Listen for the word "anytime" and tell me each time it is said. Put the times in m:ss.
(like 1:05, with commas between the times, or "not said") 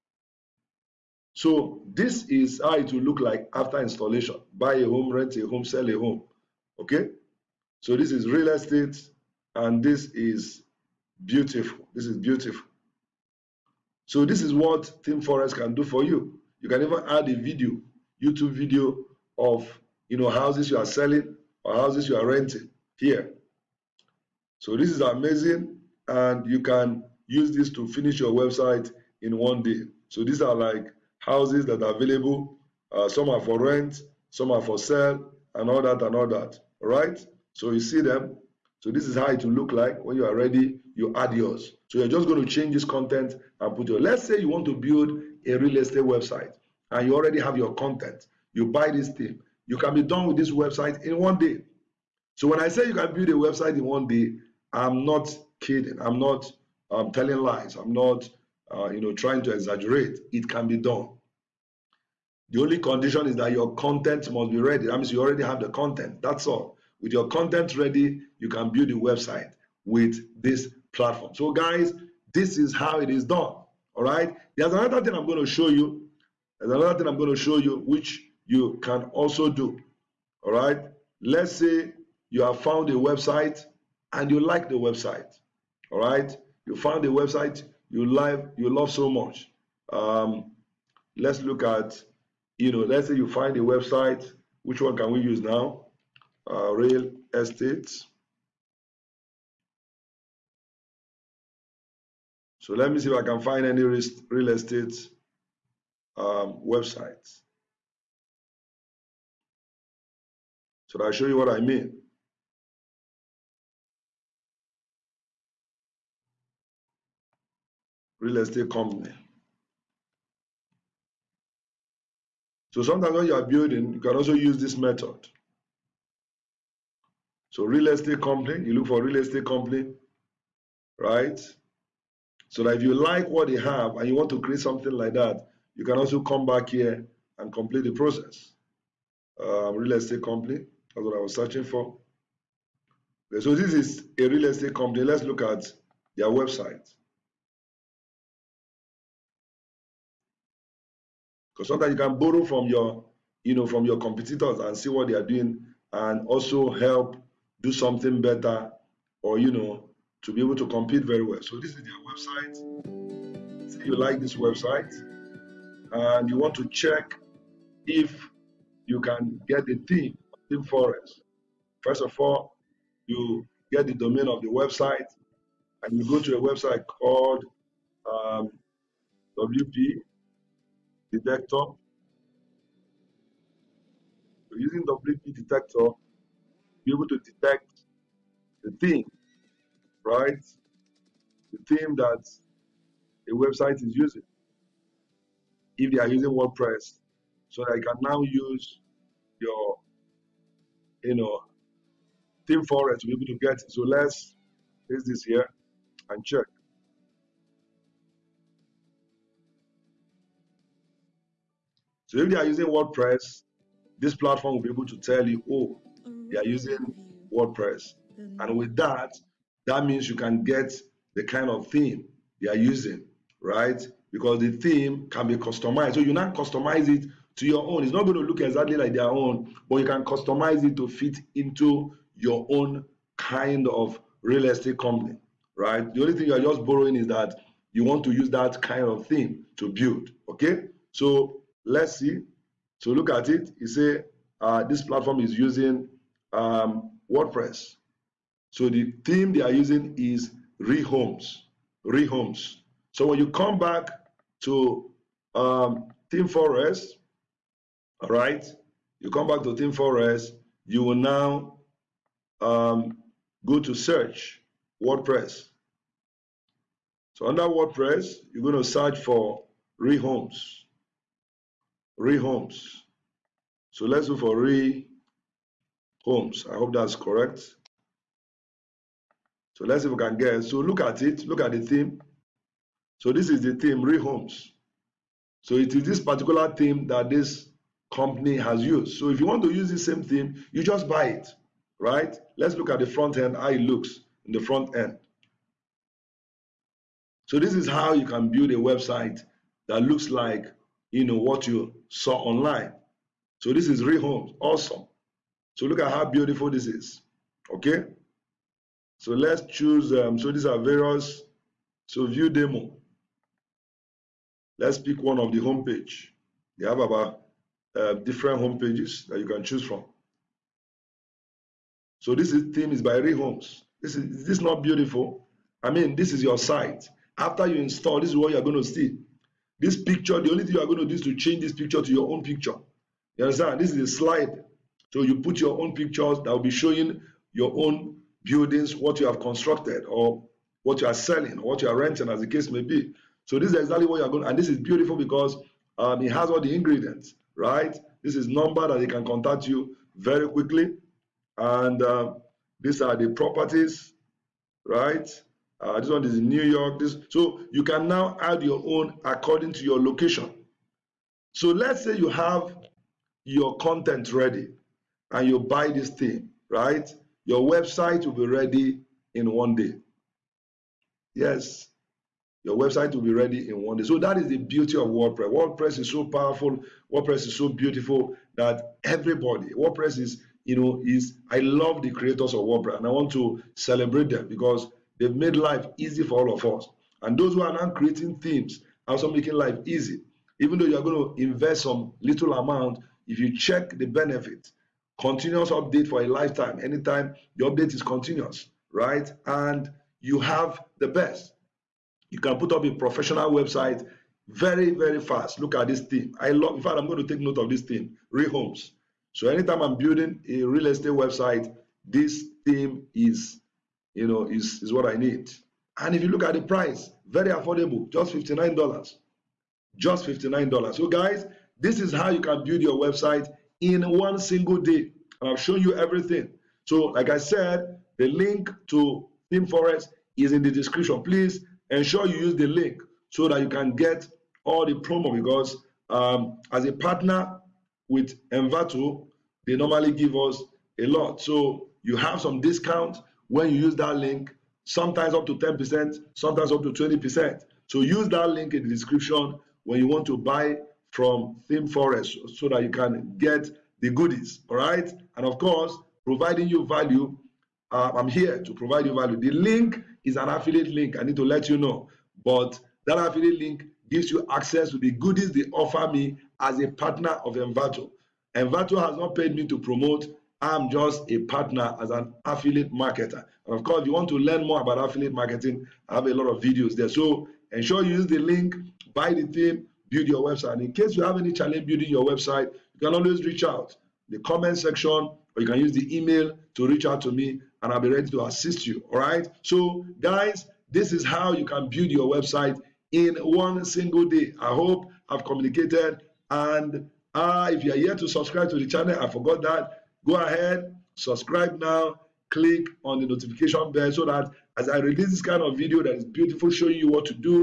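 6:36, 6:49.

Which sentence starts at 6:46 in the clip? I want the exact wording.
I love, in fact, I'm going to take note of this team, Rehomes.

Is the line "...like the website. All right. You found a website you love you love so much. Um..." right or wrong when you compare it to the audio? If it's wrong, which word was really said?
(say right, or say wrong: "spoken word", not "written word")
right.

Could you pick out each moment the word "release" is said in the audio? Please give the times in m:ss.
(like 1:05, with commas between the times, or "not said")
8:24.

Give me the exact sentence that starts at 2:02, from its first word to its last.
So sometimes when you are building, you can also use this method.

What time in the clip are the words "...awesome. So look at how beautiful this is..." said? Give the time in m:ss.
5:04.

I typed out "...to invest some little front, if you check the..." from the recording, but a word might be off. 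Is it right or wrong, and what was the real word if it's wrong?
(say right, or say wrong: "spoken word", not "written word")
wrong: "amount", not "front".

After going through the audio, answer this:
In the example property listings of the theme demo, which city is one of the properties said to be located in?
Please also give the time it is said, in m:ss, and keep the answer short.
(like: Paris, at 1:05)
New York, at 5:56.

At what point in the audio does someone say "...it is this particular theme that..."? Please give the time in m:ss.
4:45.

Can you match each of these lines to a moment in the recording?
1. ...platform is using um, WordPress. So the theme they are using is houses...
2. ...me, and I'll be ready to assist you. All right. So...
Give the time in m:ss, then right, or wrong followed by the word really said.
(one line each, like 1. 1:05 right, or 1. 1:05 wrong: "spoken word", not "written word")
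1. 4:04 wrong: "rehomes", not "houses"
2. 8:07 right.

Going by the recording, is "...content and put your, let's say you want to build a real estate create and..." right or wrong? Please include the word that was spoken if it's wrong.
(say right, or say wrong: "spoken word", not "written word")
wrong: "website", not "create".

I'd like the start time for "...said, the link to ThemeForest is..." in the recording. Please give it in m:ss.
7:07.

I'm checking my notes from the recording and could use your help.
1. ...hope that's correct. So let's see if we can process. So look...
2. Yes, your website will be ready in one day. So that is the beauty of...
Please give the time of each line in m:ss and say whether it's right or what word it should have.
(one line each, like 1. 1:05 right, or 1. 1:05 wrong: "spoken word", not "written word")
1. 4:36 wrong: "guess", not "process"
2. 6:11 right.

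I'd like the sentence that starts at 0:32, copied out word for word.
Uh, some are for rent, some are for sale, and all that and all that.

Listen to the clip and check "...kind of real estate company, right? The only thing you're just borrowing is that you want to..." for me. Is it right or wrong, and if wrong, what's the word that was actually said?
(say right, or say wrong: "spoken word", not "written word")
right.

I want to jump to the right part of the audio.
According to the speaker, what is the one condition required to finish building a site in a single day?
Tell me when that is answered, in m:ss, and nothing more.
1:03.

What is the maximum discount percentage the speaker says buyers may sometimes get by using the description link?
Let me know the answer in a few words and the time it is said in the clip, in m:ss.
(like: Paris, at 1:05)
20%, at 7:26.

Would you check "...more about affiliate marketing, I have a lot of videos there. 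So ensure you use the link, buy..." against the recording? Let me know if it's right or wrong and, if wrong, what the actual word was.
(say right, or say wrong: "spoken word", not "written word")
right.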